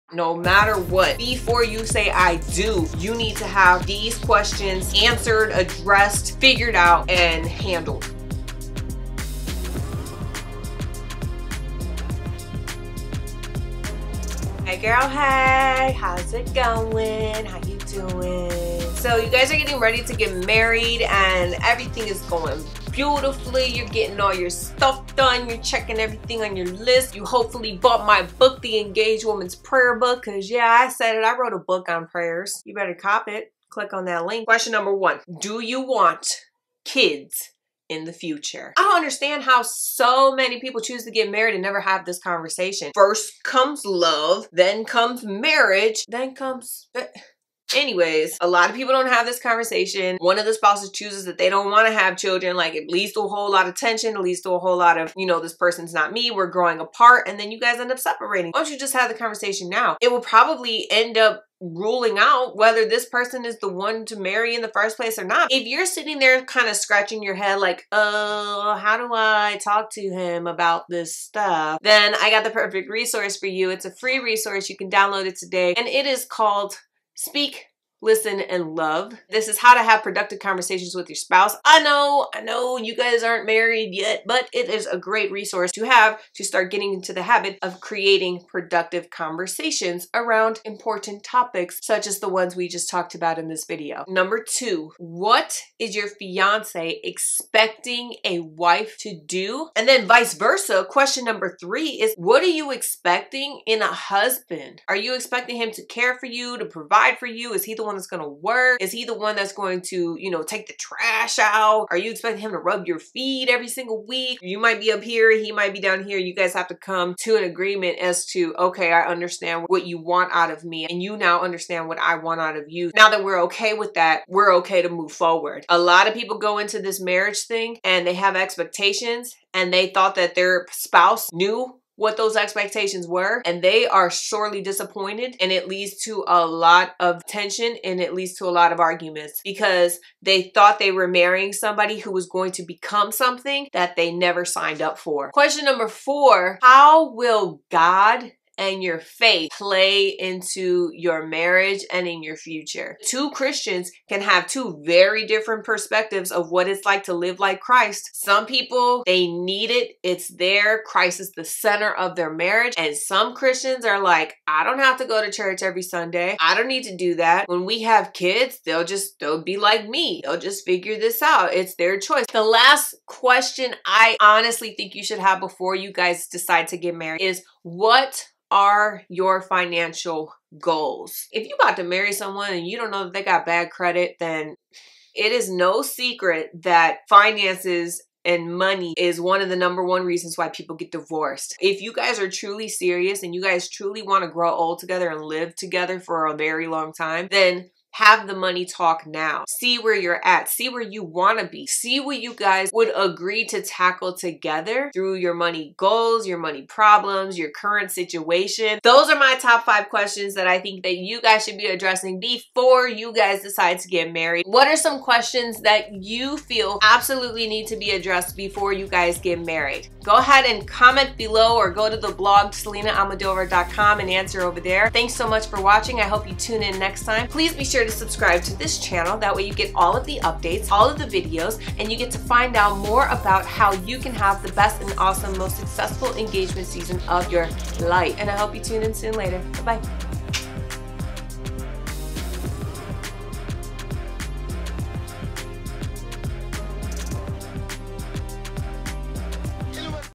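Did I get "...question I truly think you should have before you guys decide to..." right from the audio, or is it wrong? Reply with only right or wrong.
wrong.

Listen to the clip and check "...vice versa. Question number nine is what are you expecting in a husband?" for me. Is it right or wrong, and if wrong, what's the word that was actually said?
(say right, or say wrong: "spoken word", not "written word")
wrong: "three", not "nine".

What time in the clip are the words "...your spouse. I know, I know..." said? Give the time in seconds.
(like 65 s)
81 s.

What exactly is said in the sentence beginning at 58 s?
Why don't you just have the conversation now?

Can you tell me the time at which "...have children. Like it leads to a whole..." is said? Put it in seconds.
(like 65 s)
51 s.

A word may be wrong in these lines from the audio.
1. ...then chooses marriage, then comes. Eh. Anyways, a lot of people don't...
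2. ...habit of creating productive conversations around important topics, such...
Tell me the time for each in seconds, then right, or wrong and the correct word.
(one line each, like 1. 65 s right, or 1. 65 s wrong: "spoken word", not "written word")
1. 44 s wrong: "comes", not "chooses"
2. 87 s right.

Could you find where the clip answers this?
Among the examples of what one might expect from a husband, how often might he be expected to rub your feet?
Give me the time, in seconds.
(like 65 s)
113 s.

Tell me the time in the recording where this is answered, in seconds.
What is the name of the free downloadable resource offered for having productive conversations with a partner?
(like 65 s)
77 s.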